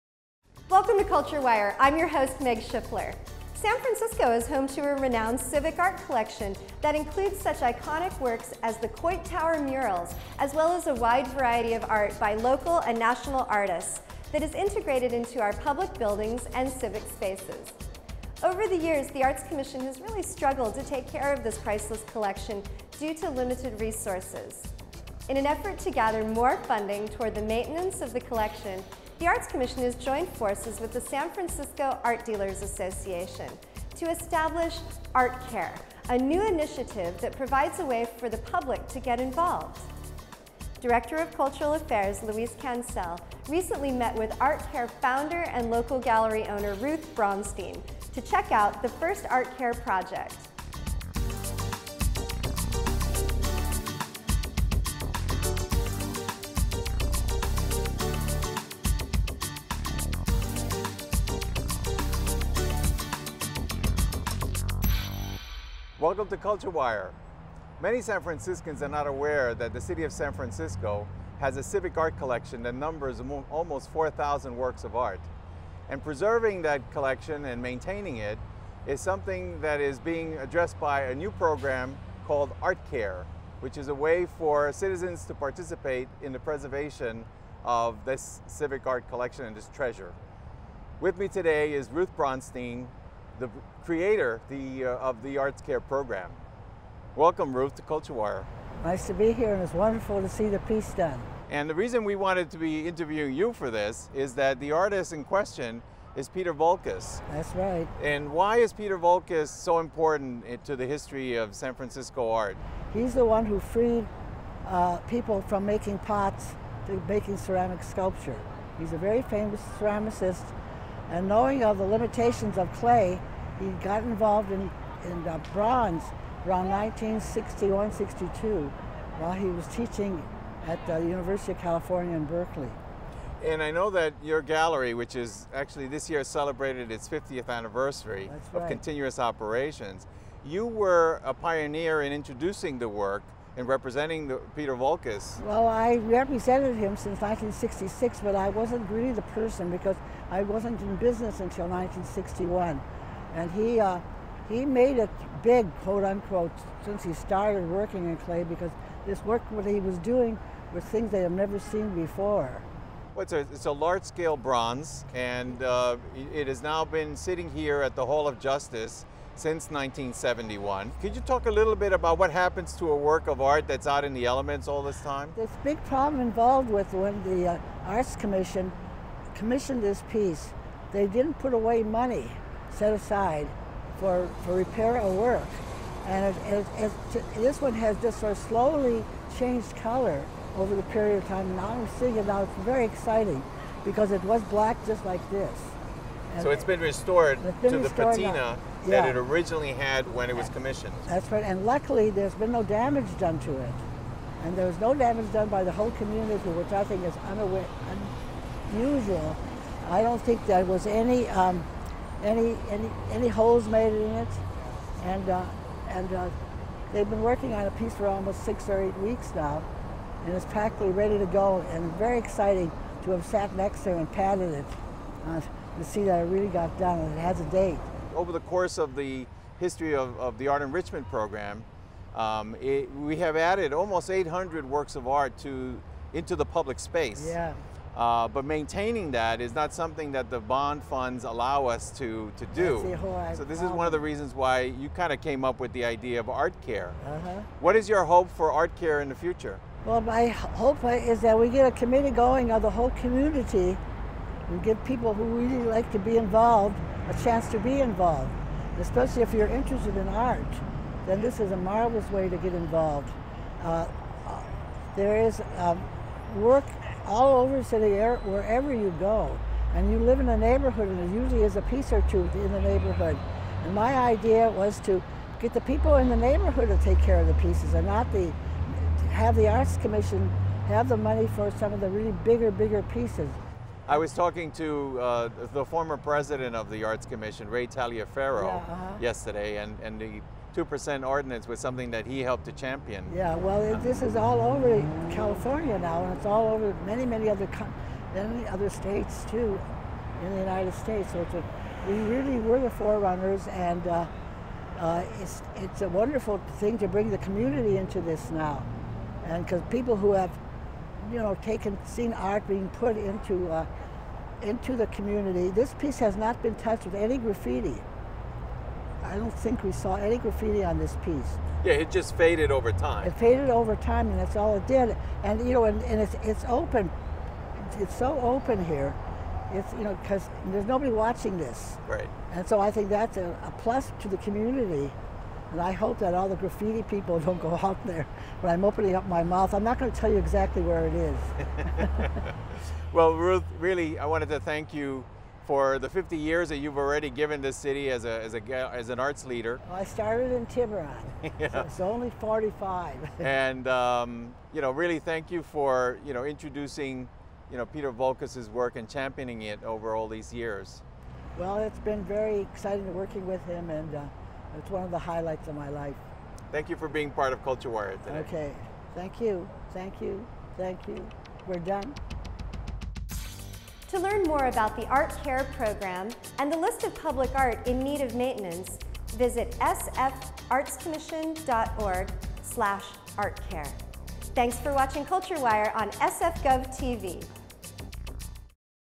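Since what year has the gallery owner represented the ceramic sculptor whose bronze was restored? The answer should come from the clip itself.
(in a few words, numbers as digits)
1966.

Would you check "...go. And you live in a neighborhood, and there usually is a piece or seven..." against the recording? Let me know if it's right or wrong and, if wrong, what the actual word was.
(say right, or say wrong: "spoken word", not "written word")
wrong: "two", not "seven".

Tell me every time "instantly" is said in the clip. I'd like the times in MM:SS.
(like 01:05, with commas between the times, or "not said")
not said.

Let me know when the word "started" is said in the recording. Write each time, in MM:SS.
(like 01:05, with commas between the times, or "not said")
02:37, 05:49.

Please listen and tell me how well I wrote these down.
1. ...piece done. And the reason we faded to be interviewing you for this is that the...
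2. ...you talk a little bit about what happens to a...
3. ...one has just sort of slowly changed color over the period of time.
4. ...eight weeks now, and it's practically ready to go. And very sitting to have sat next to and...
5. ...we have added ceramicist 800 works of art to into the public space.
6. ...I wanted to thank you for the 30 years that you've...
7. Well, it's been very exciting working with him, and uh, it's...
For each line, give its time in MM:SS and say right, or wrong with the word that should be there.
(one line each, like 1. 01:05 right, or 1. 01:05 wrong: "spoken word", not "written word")
1. 01:40 wrong: "wanted", not "faded"
2. 02:51 right
3. 03:07 right
4. 03:38 wrong: "exciting", not "sitting"
5. 03:52 wrong: "almost", not "ceramicist"
6. 05:43 wrong: "50", not "30"
7. 06:01 right.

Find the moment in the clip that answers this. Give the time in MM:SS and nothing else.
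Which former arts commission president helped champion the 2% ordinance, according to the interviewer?
04:47.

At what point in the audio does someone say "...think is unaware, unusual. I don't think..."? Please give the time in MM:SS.
03:26.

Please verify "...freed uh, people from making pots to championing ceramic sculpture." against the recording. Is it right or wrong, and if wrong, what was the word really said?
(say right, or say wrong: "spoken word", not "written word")
wrong: "making", not "championing".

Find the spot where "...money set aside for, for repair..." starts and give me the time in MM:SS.
03:01.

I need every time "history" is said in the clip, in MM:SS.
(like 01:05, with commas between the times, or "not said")
01:50, 03:49.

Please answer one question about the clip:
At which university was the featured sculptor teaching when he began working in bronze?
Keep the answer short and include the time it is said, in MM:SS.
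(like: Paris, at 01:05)
University of California in Berkeley, at 02:10.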